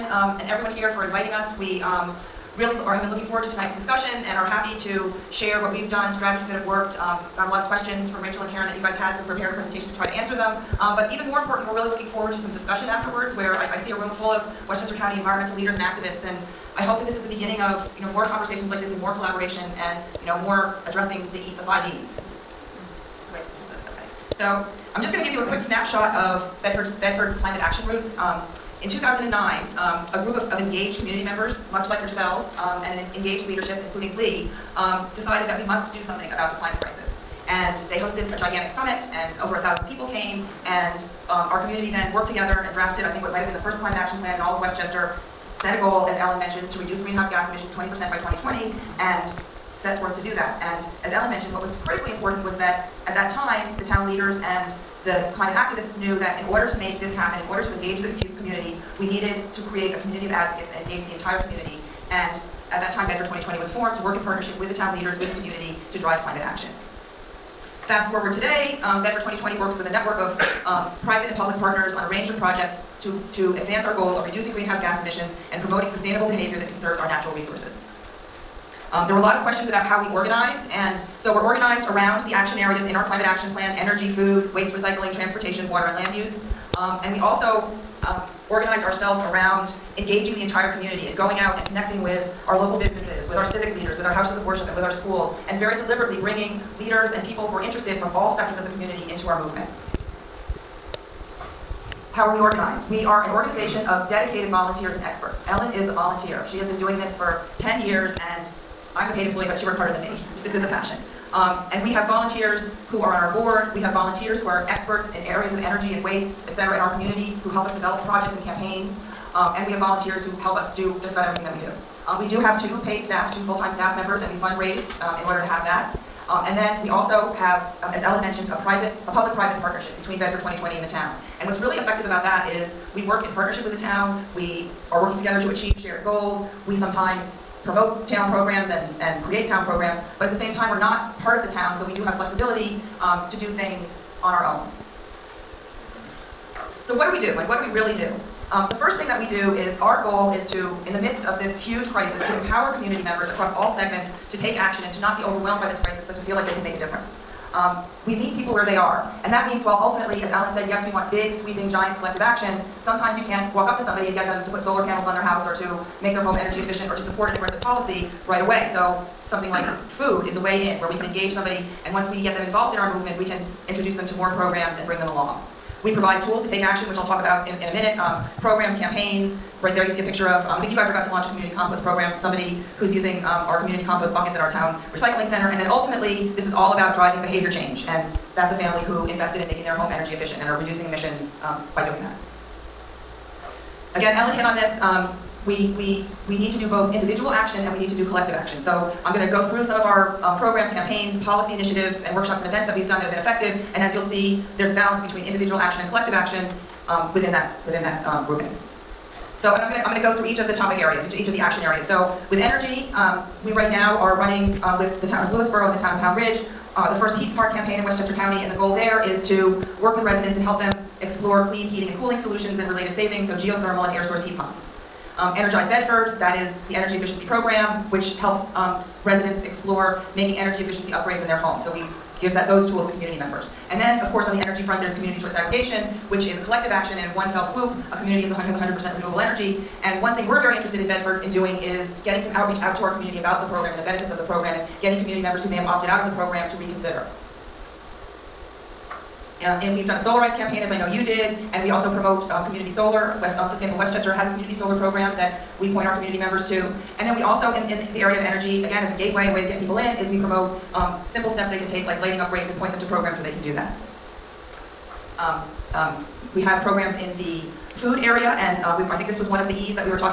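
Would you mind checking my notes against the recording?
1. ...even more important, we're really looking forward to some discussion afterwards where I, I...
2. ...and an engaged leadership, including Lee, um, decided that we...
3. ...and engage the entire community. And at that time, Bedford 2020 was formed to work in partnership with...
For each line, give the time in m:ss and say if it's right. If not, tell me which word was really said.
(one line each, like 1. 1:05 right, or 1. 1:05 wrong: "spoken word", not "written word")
1. 0:11 right
2. 0:32 right
3. 1:00 right.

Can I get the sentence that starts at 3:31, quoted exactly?
So with energy, um, we right now are running uh, with the town of Lewisboro and the town of Pound Ridge.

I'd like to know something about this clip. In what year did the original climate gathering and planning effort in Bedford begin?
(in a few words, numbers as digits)
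2009.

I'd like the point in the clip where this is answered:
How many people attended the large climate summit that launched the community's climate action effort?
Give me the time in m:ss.
0:39.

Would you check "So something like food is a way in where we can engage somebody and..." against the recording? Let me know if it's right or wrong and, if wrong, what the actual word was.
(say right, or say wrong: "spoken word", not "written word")
right.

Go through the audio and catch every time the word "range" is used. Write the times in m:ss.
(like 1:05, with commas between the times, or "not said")
1:12.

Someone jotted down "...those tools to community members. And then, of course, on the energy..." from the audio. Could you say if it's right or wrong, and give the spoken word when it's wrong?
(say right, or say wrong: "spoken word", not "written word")
right.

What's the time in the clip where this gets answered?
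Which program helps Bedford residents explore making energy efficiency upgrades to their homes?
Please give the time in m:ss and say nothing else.
3:45.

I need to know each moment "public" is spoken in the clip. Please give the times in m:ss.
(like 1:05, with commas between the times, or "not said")
1:11, 2:09.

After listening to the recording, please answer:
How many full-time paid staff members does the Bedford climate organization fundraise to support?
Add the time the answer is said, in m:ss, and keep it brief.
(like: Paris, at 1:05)
2, at 2:03.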